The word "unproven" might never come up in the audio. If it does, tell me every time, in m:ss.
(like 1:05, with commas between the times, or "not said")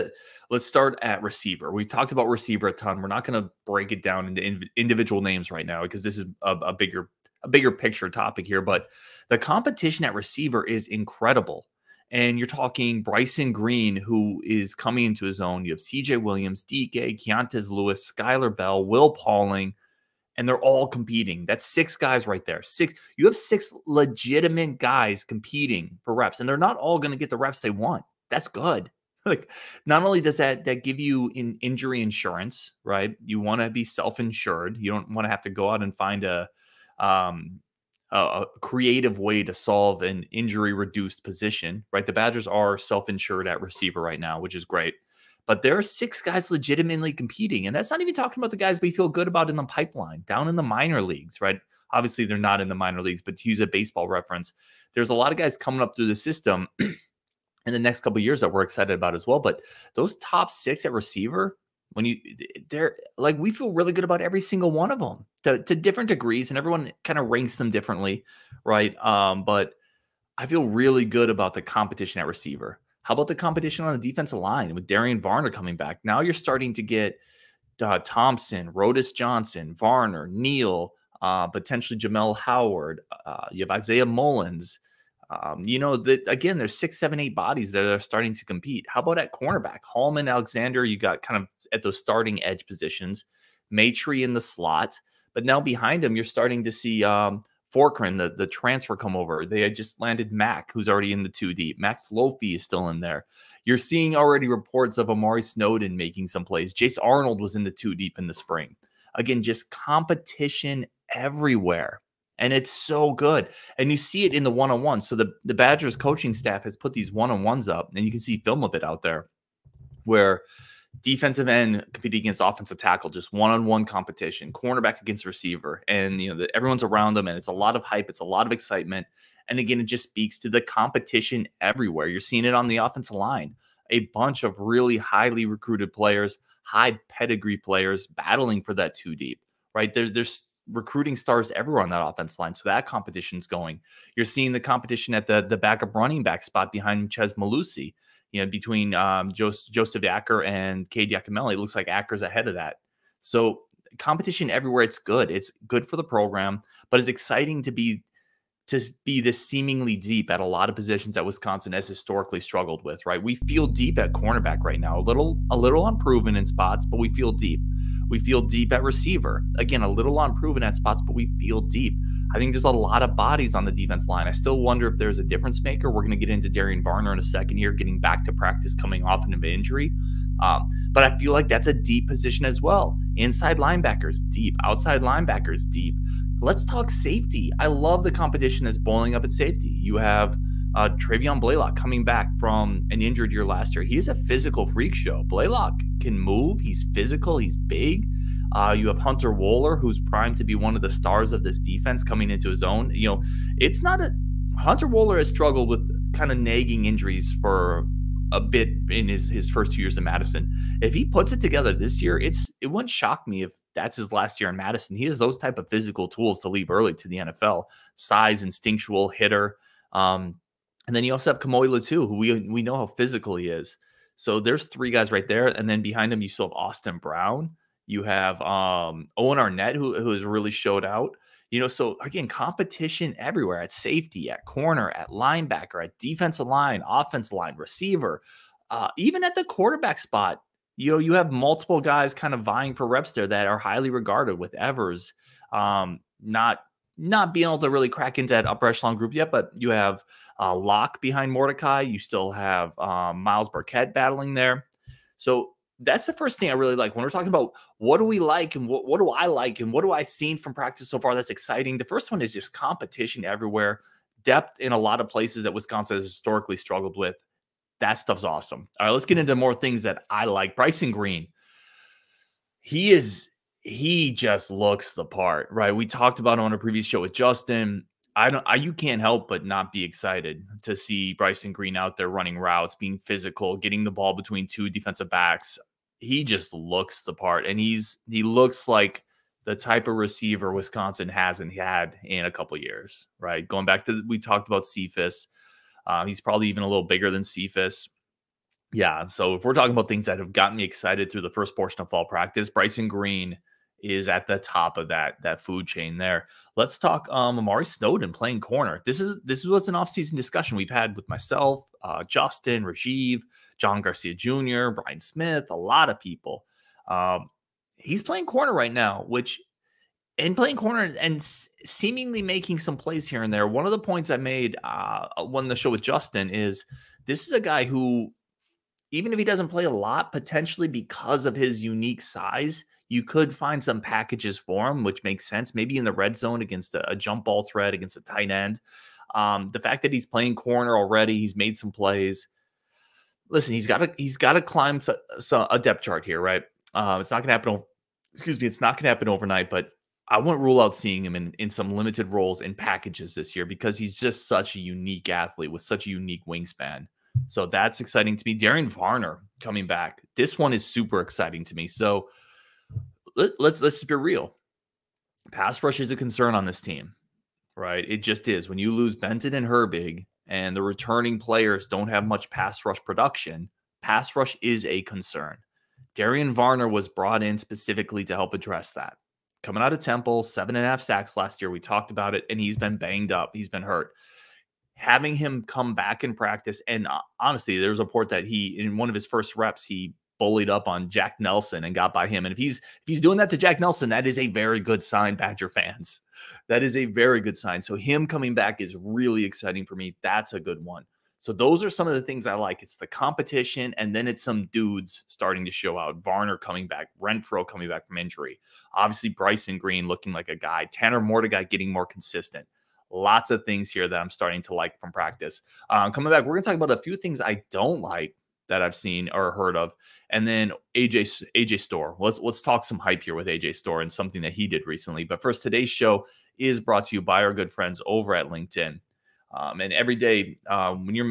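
2:45, 2:50.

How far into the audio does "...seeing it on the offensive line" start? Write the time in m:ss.
2:12.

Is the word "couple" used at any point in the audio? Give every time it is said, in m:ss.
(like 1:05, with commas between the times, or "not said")
0:57, 4:52.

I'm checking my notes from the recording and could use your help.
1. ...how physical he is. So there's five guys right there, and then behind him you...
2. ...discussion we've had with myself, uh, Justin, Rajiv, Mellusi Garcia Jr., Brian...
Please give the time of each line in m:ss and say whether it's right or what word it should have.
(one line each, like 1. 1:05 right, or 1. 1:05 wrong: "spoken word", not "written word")
1. 3:42 wrong: "three", not "five"
2. 5:10 wrong: "John", not "Mellusi".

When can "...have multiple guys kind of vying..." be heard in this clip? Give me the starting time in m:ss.
4:01.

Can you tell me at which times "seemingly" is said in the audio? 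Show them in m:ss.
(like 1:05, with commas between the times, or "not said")
2:39, 5:21.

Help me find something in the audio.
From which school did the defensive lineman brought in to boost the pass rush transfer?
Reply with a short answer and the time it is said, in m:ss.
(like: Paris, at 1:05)
Temple, at 6:19.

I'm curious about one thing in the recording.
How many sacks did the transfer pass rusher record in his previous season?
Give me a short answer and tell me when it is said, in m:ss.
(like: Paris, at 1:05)
7.5, at 6:20.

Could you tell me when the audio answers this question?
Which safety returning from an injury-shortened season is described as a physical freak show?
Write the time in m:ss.
3:10.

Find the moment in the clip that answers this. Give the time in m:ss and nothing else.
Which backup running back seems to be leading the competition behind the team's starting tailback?
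2:31.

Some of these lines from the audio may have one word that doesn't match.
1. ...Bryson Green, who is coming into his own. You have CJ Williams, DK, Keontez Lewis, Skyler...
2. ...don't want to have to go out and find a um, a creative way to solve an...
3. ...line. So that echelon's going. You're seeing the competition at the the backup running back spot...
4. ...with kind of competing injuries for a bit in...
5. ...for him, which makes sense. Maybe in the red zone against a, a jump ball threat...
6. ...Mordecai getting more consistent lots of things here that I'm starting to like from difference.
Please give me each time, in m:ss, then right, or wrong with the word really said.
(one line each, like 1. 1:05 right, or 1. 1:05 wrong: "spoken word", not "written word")
1. 0:13 right
2. 0:34 right
3. 2:22 wrong: "competition", not "echelon"
4. 3:25 wrong: "nagging", not "competing"
5. 5:34 right
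6. 6:51 wrong: "practice", not "difference".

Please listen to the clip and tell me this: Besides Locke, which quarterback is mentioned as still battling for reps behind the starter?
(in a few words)
Myles Burkett.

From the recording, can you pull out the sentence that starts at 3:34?
He has those type of physical tools to leave early to the NFL.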